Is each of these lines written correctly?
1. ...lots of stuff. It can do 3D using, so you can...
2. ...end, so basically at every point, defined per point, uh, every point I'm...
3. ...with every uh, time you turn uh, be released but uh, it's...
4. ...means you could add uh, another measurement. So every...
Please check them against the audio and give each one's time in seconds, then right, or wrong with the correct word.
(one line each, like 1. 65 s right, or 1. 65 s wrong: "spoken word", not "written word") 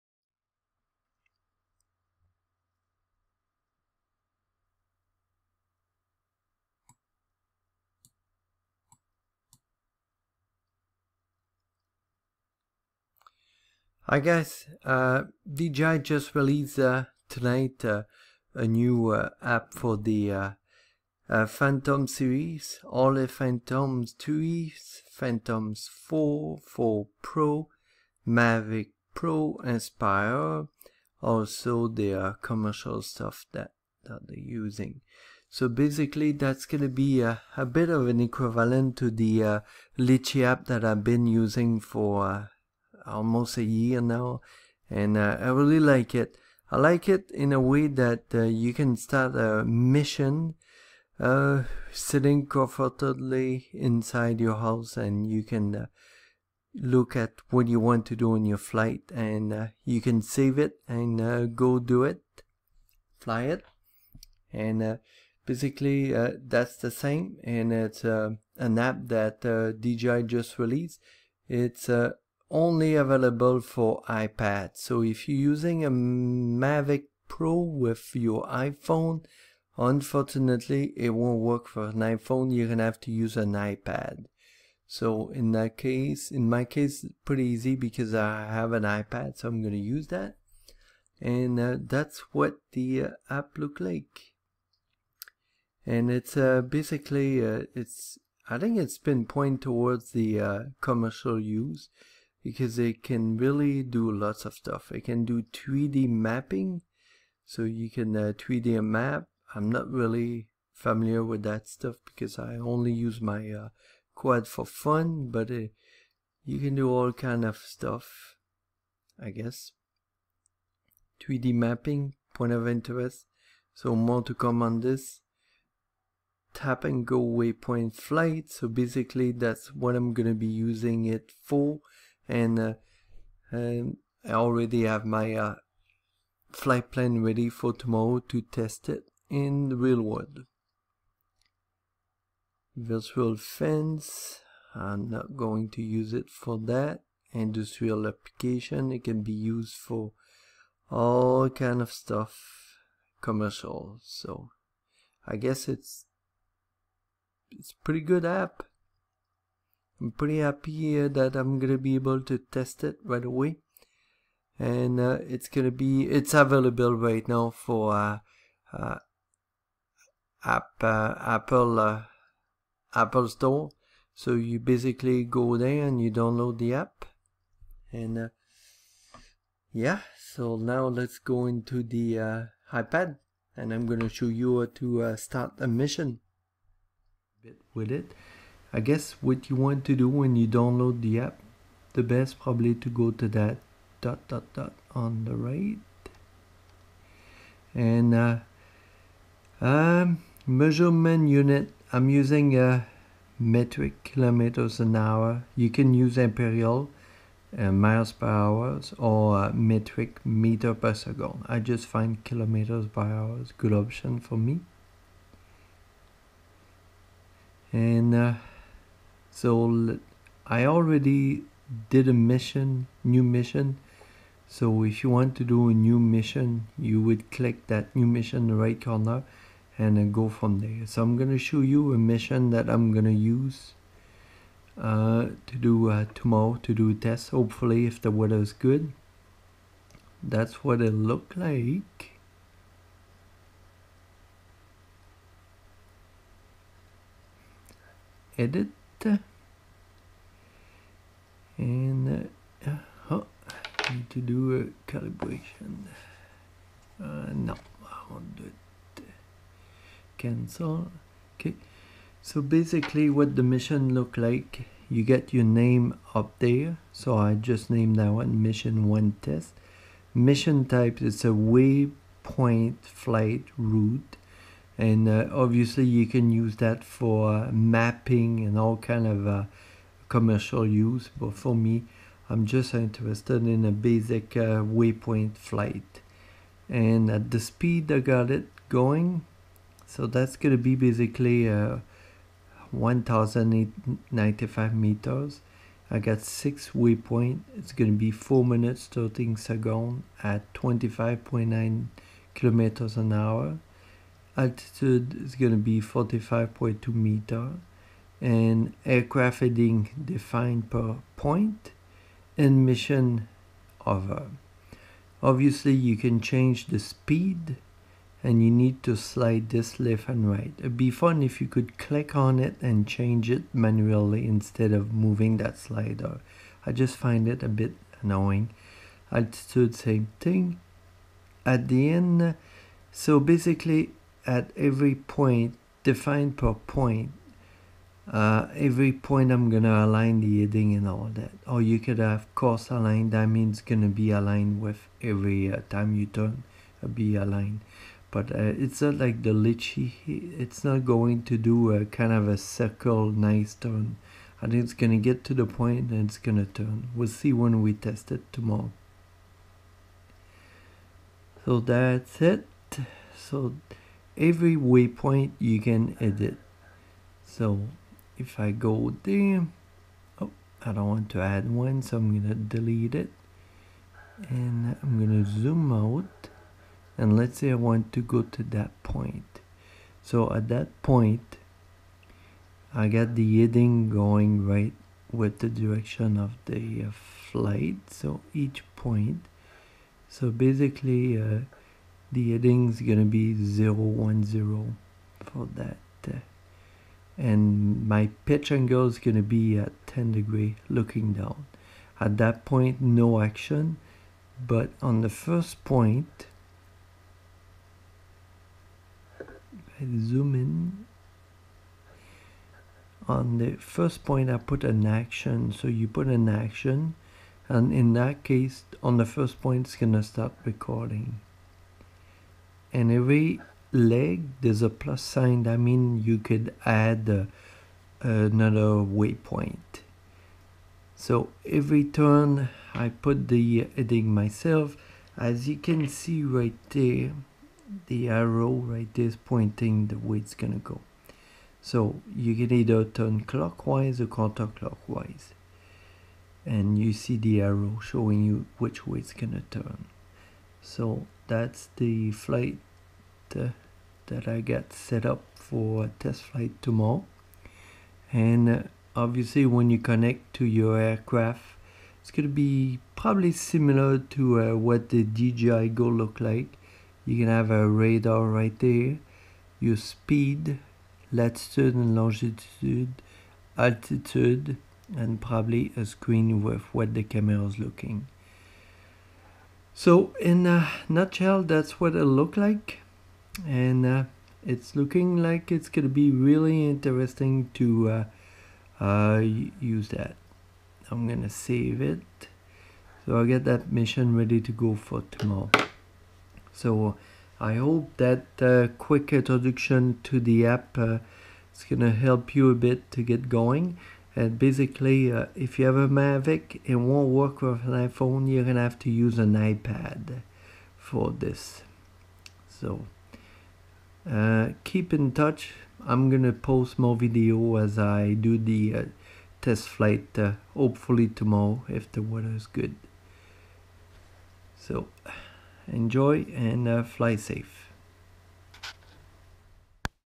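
1. 104 s wrong: "mapping", not "using"
2. 331 s right
3. 344 s wrong: "aligned", not "released"
4. 425 s wrong: "waypoint", not "measurement".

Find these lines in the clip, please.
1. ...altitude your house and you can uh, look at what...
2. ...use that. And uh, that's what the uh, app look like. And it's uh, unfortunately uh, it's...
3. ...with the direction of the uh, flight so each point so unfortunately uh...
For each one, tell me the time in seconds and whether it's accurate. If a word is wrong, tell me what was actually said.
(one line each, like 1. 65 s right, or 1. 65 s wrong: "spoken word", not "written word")
1. 53 s wrong: "inside", not "altitude"
2. 89 s wrong: "basically", not "unfortunately"
3. 385 s wrong: "basically", not "unfortunately".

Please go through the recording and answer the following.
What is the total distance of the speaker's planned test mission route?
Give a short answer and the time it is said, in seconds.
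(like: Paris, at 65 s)
1,095 meters, at 292 s.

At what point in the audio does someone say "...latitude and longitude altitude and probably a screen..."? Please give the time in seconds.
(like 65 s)
471 s.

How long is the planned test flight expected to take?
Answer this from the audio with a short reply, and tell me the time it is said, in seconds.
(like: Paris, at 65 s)
4 minutes 13 seconds, at 298 s.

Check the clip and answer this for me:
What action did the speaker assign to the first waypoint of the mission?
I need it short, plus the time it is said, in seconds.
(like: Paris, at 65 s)
start recording, at 420 s.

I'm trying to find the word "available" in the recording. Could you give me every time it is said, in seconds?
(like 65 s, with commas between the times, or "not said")
72 s, 166 s.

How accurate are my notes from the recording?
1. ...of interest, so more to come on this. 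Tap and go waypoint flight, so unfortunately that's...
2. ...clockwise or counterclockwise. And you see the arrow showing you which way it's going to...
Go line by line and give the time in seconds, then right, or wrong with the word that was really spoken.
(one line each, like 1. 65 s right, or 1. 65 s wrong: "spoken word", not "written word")
1. 122 s wrong: "basically", not "unfortunately"
2. 443 s right.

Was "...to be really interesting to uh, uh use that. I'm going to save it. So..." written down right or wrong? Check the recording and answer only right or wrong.
right.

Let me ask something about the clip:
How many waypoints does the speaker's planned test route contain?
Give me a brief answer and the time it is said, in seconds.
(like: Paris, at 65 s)
6, at 296 s.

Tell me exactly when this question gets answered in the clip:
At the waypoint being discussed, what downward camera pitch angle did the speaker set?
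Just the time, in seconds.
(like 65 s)
399 s.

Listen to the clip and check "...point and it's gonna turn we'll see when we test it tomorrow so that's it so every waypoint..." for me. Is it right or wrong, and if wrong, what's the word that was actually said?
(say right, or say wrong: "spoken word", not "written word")
right.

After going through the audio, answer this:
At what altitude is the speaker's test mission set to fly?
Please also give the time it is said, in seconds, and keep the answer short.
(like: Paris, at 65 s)
45.2 meters, at 305 s.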